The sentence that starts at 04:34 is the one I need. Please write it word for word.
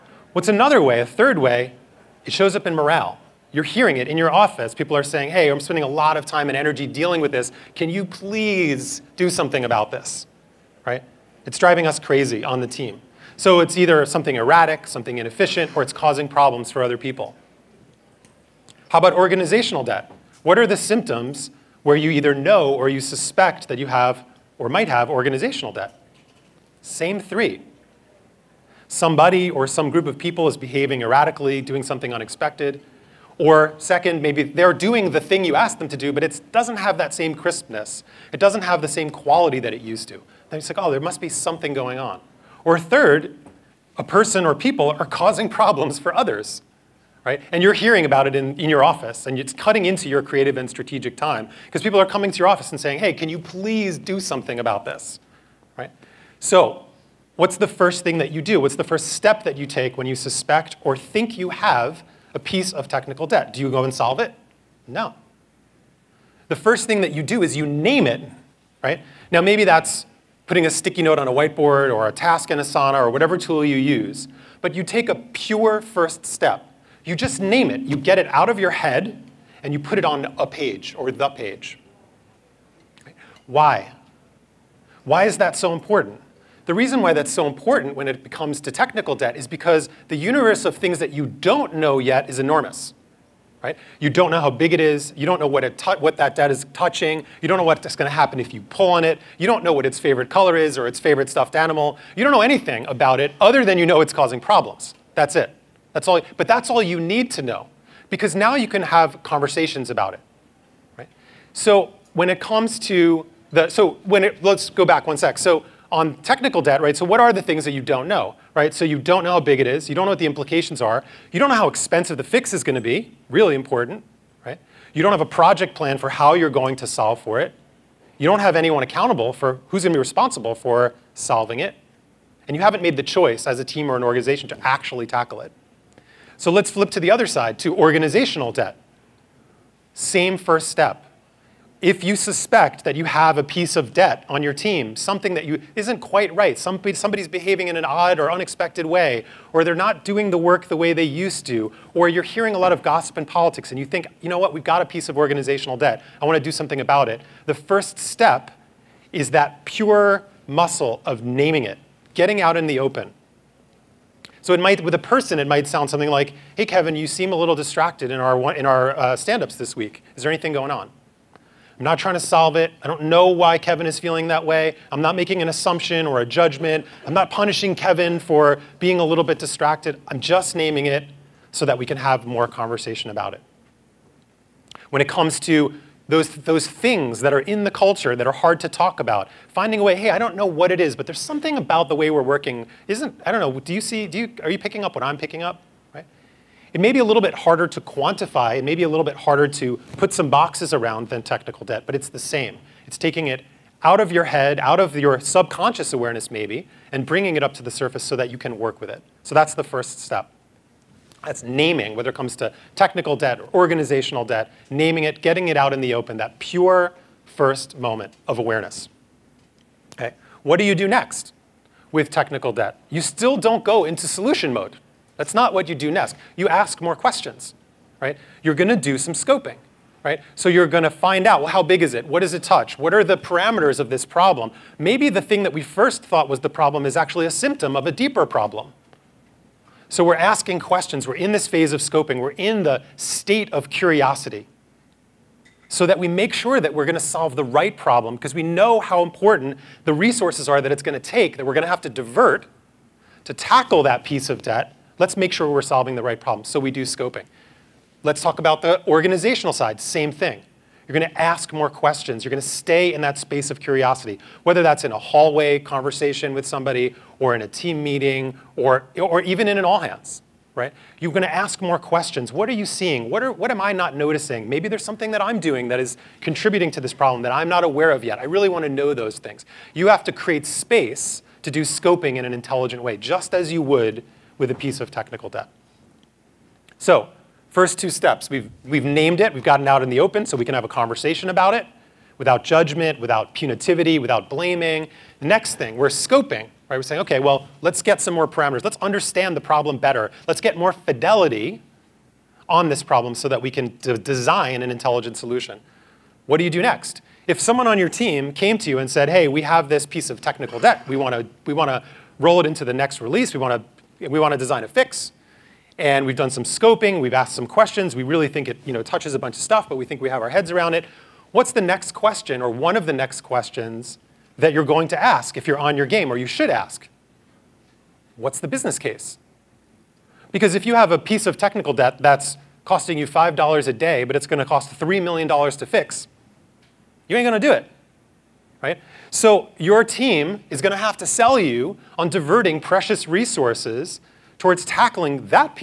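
Maybe there's something that I'm doing that is contributing to this problem that I'm not aware of yet.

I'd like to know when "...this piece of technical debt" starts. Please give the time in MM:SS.
05:09.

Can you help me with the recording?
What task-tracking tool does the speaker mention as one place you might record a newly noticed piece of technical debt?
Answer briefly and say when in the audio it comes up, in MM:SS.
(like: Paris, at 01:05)
Asana, at 01:12.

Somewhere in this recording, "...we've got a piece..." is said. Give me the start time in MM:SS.
02:34.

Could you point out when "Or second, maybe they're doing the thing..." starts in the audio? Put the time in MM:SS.
00:33.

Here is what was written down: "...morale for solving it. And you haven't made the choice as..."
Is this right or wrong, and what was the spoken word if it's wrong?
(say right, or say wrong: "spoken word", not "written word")
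wrong: "responsible", not "morale".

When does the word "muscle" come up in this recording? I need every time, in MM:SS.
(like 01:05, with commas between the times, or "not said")
02:40.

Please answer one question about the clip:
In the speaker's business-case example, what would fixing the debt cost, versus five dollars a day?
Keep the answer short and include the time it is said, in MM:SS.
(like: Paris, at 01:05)
$3 million, at 05:34.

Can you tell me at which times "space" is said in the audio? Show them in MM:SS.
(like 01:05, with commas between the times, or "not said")
04:23, 04:40.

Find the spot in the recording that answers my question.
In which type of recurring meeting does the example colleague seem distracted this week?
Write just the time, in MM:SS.
02:49.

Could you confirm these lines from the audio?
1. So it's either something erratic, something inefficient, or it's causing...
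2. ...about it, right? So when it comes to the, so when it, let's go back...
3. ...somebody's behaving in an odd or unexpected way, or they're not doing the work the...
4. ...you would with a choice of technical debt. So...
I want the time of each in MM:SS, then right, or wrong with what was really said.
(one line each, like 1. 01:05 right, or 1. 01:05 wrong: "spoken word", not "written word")
1. 00:13 right
2. 01:49 right
3. 02:26 right
4. 04:43 wrong: "piece", not "choice".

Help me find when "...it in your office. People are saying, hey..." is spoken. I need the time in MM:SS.
00:03.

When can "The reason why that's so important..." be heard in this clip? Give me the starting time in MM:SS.
01:26.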